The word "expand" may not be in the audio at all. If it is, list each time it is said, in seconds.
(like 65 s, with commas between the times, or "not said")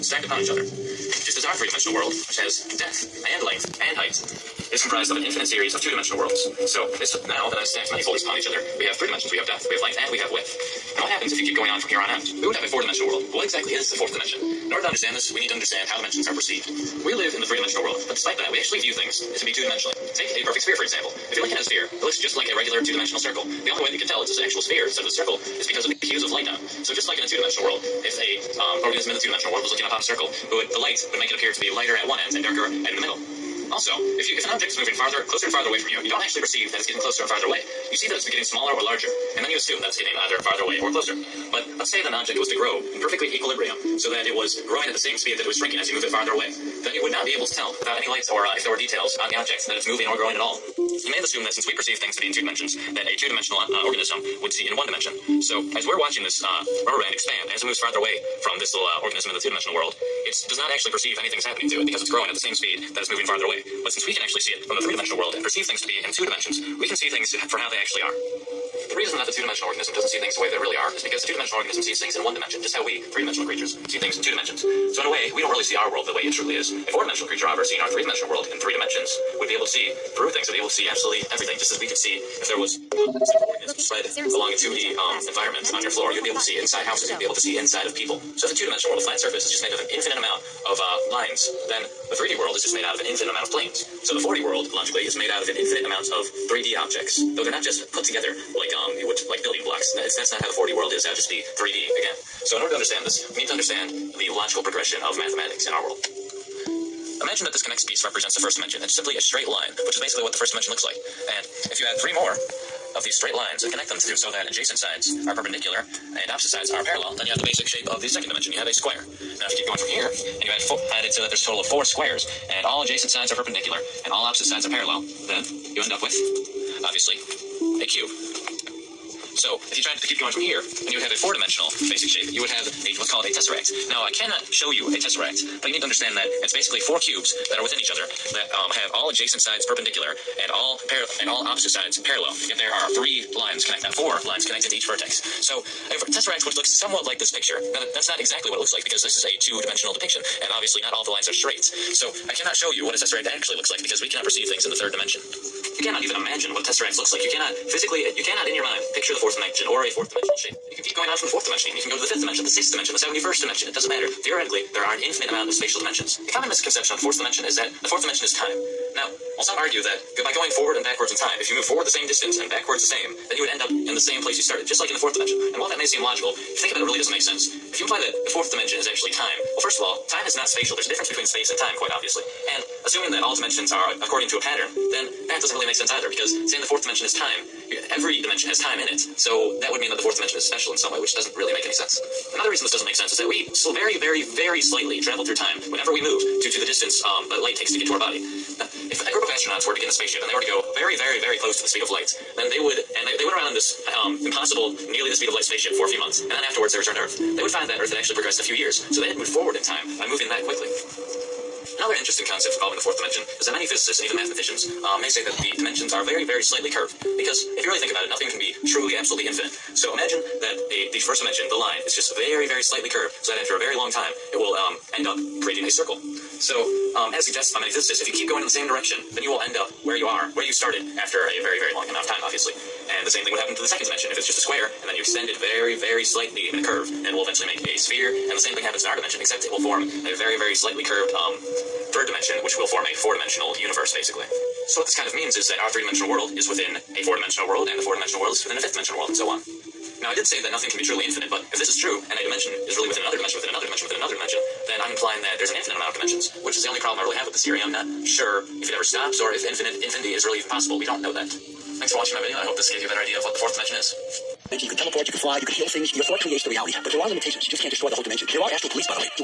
57 s.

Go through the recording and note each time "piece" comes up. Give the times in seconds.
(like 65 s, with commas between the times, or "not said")
107 s.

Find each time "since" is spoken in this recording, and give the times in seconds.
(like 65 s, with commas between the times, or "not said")
51 s, 63 s.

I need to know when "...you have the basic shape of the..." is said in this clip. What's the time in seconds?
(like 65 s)
117 s.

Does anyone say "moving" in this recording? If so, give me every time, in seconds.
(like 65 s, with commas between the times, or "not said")
34 s, 49 s, 63 s, 210 s.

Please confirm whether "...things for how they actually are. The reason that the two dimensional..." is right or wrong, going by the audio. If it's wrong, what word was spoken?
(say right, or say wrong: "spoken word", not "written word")
right.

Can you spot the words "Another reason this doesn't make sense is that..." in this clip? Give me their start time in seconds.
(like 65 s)
192 s.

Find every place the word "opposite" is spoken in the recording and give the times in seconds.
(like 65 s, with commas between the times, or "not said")
116 s, 124 s, 141 s.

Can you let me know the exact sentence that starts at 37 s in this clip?
You see that it's getting smaller or larger, and then you assume that it's getting either farther away or closer.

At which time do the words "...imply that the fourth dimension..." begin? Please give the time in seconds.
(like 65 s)
177 s.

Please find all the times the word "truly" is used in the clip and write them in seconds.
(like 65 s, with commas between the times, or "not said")
76 s, 218 s, 250 s.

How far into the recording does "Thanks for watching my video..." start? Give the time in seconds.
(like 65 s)
261 s.